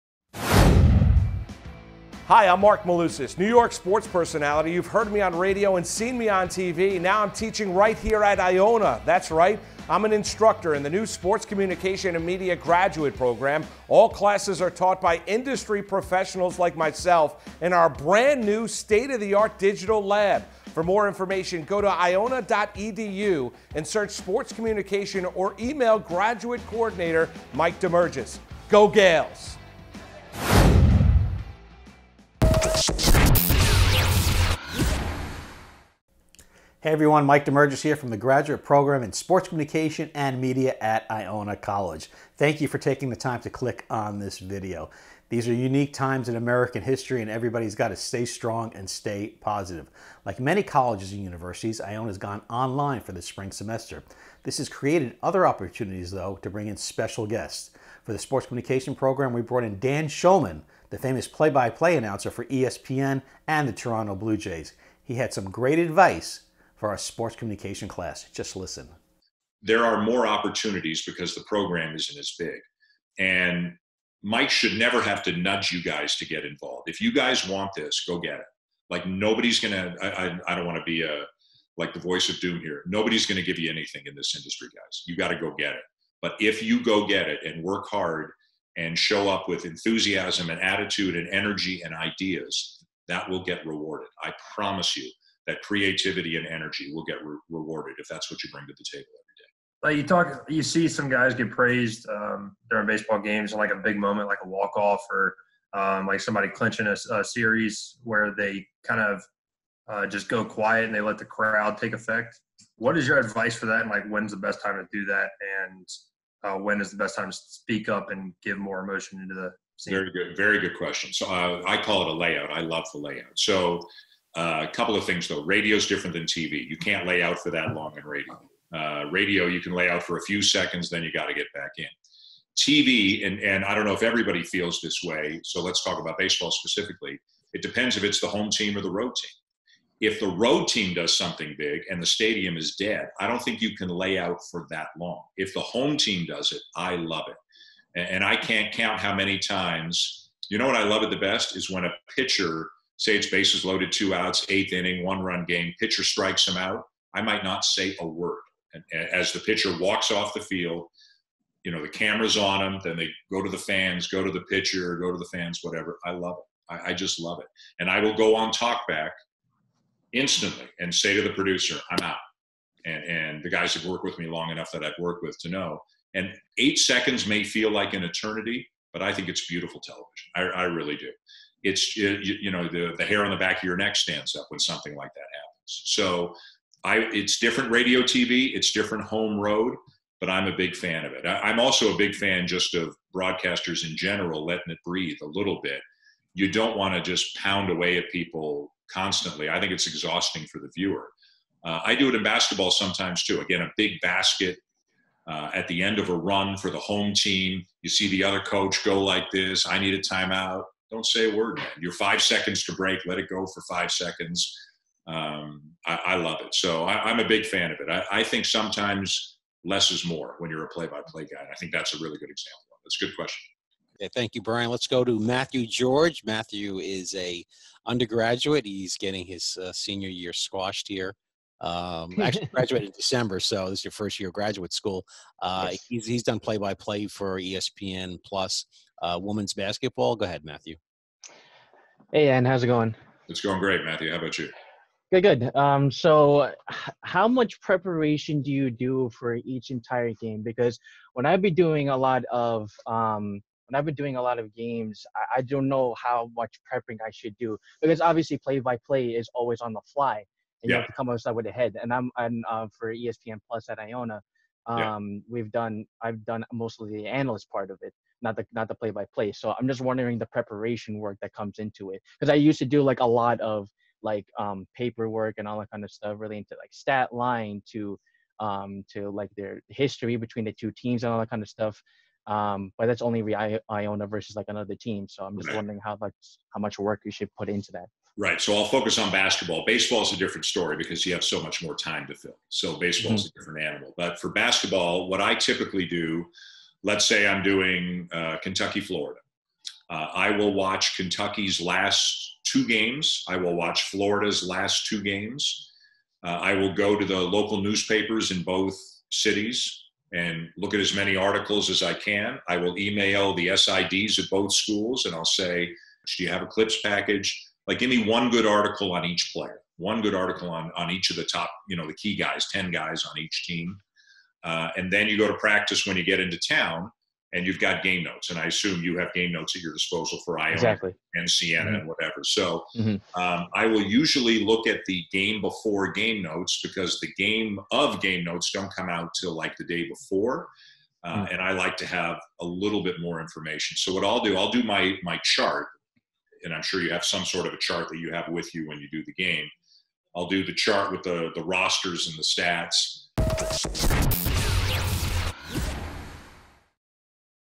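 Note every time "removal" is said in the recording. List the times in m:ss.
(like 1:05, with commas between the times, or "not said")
not said.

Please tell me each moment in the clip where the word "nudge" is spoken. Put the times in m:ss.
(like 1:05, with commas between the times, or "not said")
1:15.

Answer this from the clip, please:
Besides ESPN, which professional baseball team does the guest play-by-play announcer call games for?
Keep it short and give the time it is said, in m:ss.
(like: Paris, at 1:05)
Toronto Blue Jays, at 1:03.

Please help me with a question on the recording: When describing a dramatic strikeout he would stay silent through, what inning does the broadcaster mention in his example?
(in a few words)
eighth inning.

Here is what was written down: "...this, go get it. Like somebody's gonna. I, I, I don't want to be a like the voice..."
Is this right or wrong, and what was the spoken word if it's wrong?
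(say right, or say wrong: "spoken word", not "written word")
wrong: "nobody", not "somebody".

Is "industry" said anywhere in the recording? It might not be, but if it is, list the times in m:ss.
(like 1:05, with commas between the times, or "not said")
0:15, 1:24.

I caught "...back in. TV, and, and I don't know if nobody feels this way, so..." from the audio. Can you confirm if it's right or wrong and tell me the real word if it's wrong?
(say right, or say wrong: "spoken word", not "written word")
wrong: "everybody", not "nobody".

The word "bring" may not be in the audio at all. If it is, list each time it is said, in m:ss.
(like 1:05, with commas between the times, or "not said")
0:56, 1:38.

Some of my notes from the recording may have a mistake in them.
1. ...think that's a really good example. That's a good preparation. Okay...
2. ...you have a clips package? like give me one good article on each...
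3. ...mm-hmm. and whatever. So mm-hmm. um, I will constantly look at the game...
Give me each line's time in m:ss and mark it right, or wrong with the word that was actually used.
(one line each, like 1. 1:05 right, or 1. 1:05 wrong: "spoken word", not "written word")
1. 3:41 wrong: "question", not "preparation"
2. 5:16 right
3. 5:31 wrong: "usually", not "constantly".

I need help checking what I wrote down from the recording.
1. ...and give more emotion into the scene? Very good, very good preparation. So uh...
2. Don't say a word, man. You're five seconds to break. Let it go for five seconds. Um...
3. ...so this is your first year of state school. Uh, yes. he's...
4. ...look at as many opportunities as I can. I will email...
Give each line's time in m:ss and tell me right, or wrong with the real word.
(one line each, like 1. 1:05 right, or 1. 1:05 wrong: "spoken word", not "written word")
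1. 1:58 wrong: "question", not "preparation"
2. 3:30 right
3. 3:53 wrong: "graduate", not "state"
4. 5:10 wrong: "articles", not "opportunities".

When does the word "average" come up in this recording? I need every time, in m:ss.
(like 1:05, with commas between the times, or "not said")
not said.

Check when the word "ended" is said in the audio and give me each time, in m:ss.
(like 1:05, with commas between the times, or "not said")
not said.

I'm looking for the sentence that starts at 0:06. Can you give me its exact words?
Now I'm teaching right here at Iona.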